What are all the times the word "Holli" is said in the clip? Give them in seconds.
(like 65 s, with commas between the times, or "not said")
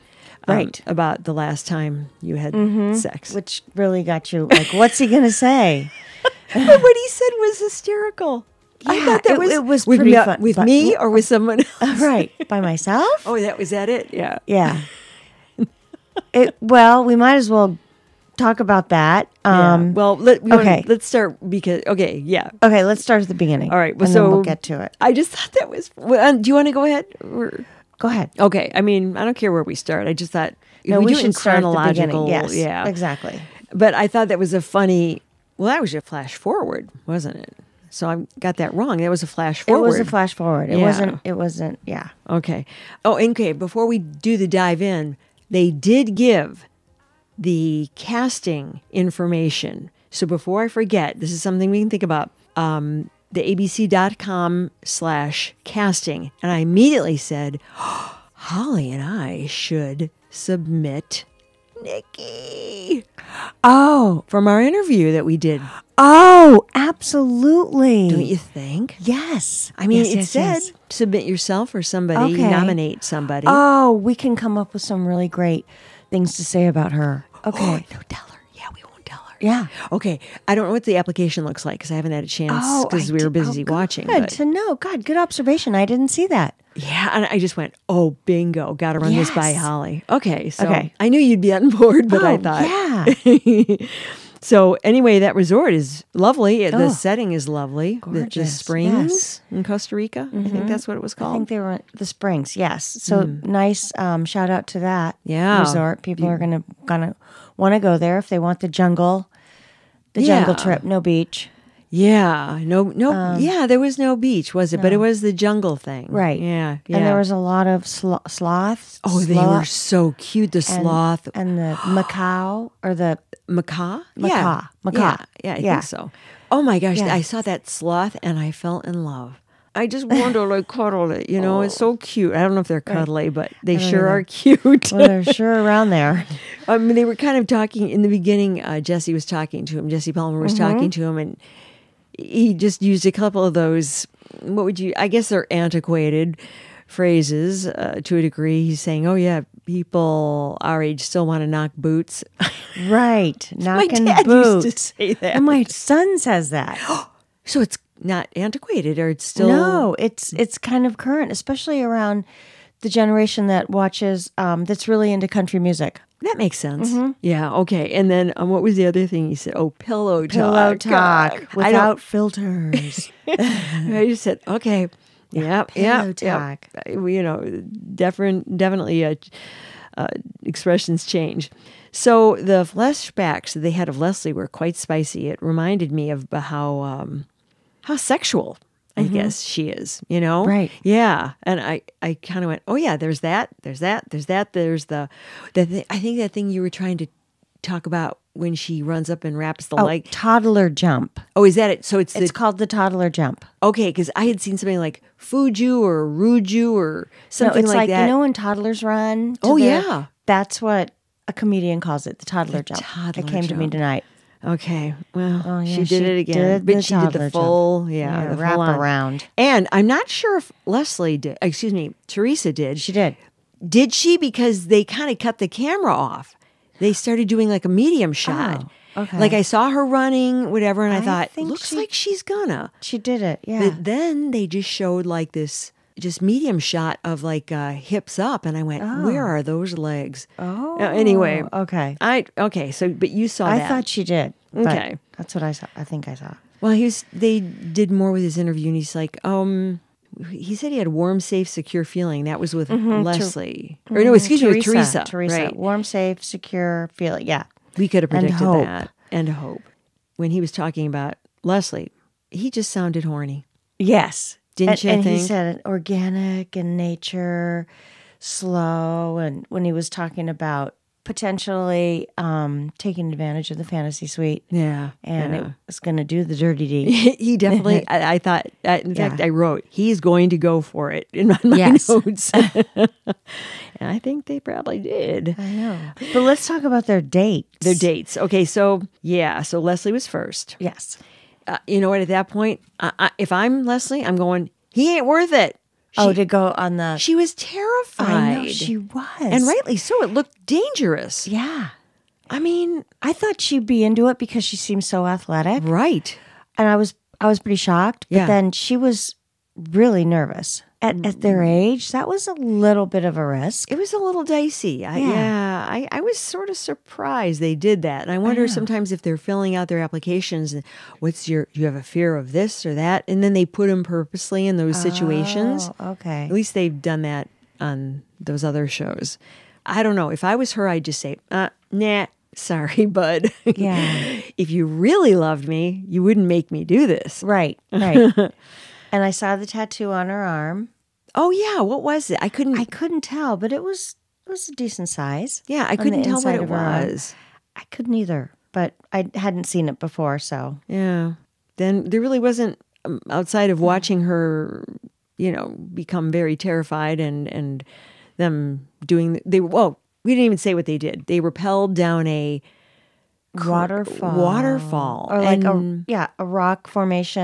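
58 s, 89 s.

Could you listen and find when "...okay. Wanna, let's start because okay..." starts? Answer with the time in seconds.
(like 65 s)
20 s.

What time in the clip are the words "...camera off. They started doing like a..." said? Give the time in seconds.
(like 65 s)
225 s.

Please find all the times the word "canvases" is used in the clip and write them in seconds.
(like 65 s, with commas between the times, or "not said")
not said.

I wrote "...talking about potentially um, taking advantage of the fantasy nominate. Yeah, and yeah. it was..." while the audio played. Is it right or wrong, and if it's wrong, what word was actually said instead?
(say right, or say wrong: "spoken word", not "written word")
wrong: "suite", not "nominate".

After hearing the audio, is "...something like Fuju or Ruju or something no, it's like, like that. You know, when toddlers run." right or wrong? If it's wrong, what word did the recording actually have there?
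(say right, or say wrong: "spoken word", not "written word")
right.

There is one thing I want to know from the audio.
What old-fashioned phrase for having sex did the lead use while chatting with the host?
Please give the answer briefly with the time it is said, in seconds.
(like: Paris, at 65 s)
knock boots, at 151 s.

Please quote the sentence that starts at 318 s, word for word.
And I wonder I sometimes if they're filling out their applications, what's your, you have a fear of this or that?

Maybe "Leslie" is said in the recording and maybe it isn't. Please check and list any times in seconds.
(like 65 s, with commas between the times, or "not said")
183 s, 220 s, 253 s, 261 s, 289 s, 293 s.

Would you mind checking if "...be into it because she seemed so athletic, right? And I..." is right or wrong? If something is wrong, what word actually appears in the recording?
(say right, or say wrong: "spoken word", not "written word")
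right.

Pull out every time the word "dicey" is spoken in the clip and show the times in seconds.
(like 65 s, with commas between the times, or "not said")
314 s.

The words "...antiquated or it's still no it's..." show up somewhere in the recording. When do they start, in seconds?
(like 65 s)
158 s.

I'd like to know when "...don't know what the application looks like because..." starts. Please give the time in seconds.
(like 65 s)
80 s.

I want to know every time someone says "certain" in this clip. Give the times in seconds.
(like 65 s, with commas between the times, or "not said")
not said.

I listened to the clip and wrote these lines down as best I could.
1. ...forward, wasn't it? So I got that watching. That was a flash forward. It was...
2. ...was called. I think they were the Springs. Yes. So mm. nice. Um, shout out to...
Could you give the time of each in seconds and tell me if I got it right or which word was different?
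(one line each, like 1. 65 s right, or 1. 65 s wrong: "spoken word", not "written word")
1. 36 s wrong: "wrong", not "watching"
2. 100 s right.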